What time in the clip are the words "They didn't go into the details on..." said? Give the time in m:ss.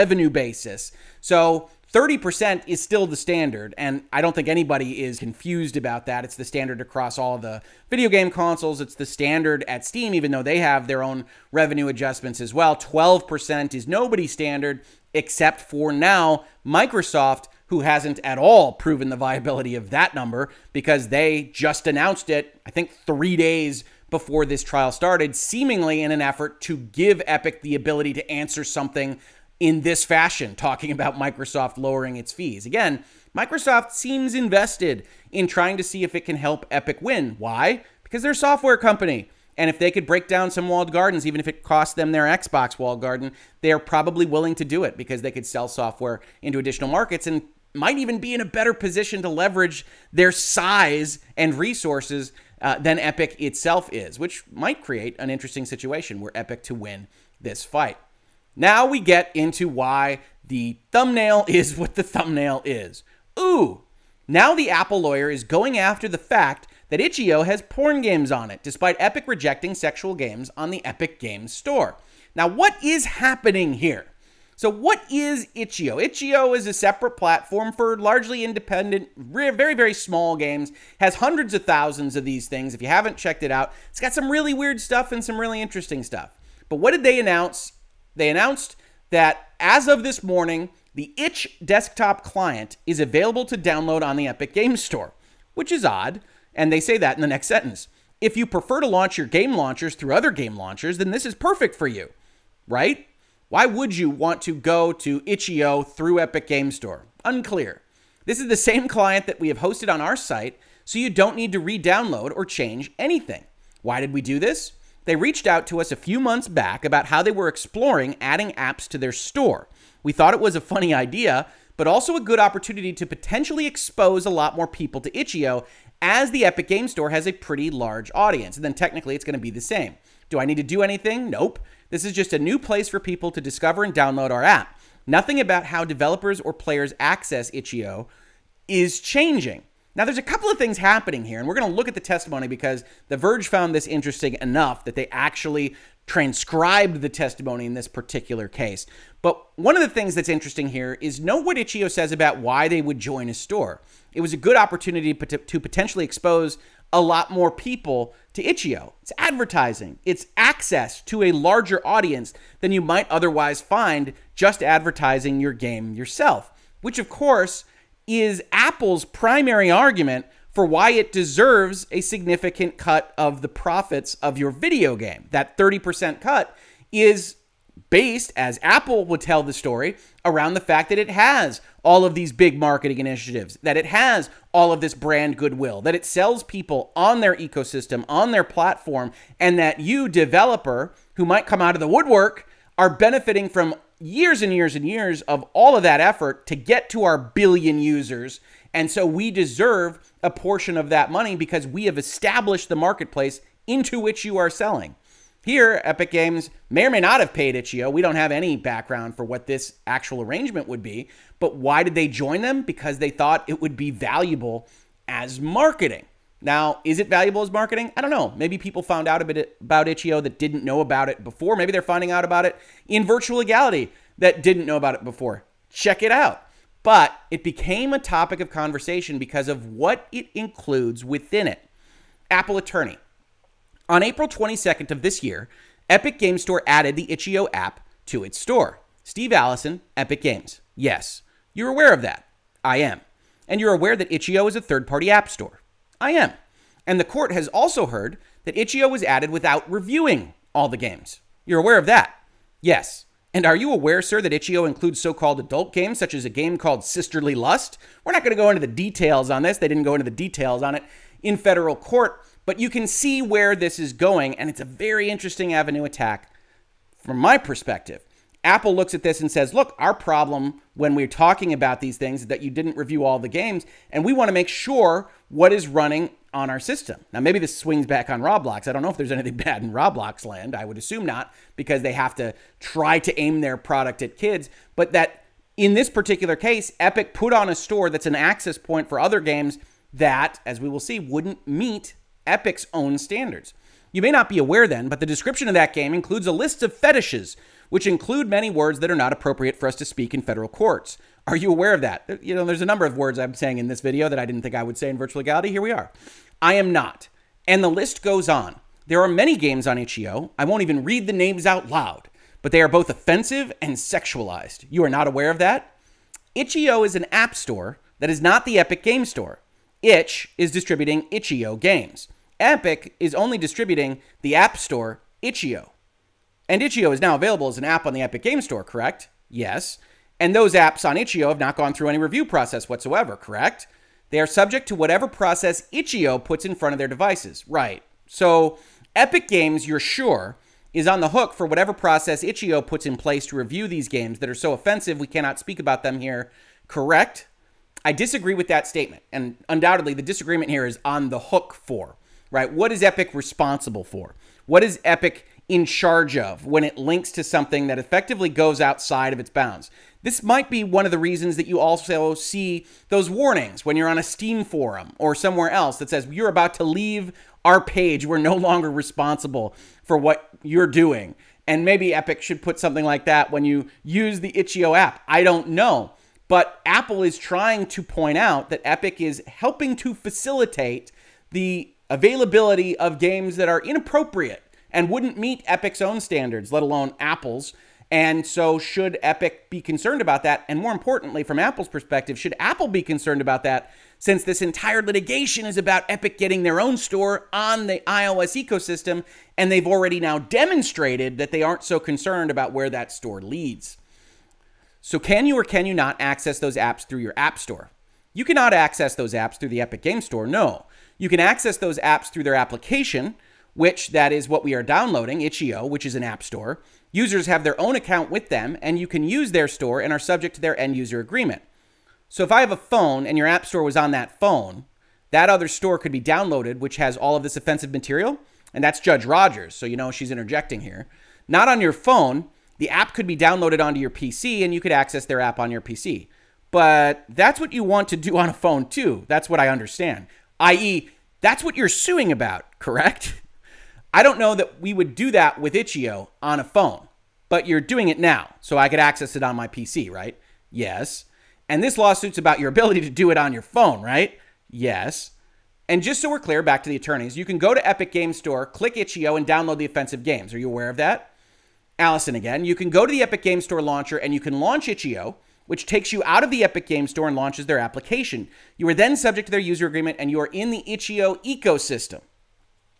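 4:19.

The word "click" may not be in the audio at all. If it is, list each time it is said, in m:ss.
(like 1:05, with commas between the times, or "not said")
7:38.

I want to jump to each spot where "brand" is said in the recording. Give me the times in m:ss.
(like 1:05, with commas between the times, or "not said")
3:04.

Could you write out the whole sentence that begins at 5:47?
I disagree with that statement, and undoubtedly the disagreement here is on the hook for right?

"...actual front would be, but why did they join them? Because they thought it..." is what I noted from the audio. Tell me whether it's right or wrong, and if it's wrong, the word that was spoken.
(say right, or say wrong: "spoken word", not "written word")
wrong: "arrangement", not "front".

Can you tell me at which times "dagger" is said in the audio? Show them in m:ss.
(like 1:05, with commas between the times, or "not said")
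not said.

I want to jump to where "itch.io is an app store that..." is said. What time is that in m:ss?
5:16.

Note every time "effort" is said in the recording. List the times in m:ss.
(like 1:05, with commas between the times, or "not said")
0:26, 3:16.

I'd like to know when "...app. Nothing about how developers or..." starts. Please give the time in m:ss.
2:14.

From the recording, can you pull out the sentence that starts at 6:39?
And they've already now demonstrated that they aren't so concerned about where that store leads.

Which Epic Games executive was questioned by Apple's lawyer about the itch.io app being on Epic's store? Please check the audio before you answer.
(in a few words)
Steve Allison.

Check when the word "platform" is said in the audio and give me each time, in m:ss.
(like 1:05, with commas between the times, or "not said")
1:17, 3:08.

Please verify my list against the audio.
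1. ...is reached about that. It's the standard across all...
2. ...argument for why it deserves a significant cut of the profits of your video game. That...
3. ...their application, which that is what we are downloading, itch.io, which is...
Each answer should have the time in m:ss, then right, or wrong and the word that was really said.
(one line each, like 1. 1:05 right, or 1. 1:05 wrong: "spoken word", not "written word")
1. 0:05 wrong: "confused", not "reached"
2. 2:49 right
3. 6:52 right.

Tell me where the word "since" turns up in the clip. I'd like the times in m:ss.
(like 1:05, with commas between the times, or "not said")
6:33.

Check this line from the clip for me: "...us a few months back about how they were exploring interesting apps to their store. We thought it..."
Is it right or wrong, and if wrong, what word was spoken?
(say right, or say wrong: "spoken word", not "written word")
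wrong: "adding", not "interesting".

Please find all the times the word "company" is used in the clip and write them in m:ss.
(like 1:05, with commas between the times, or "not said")
0:38.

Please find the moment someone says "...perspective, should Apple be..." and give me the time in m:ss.
6:31.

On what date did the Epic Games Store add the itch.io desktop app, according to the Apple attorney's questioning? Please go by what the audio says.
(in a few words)
April 22nd.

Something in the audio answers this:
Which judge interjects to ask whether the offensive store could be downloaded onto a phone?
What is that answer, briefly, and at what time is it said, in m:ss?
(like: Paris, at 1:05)
Judge Rogers, at 7:08.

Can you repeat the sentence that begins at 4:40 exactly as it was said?
I would assume not, because they have to try to aim their product at kids.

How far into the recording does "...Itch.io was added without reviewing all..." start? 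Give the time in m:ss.
4:08.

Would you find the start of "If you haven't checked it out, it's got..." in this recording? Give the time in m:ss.
1:22.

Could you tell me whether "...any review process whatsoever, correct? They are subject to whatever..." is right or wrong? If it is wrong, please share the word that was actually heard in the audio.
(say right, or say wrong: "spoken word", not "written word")
right.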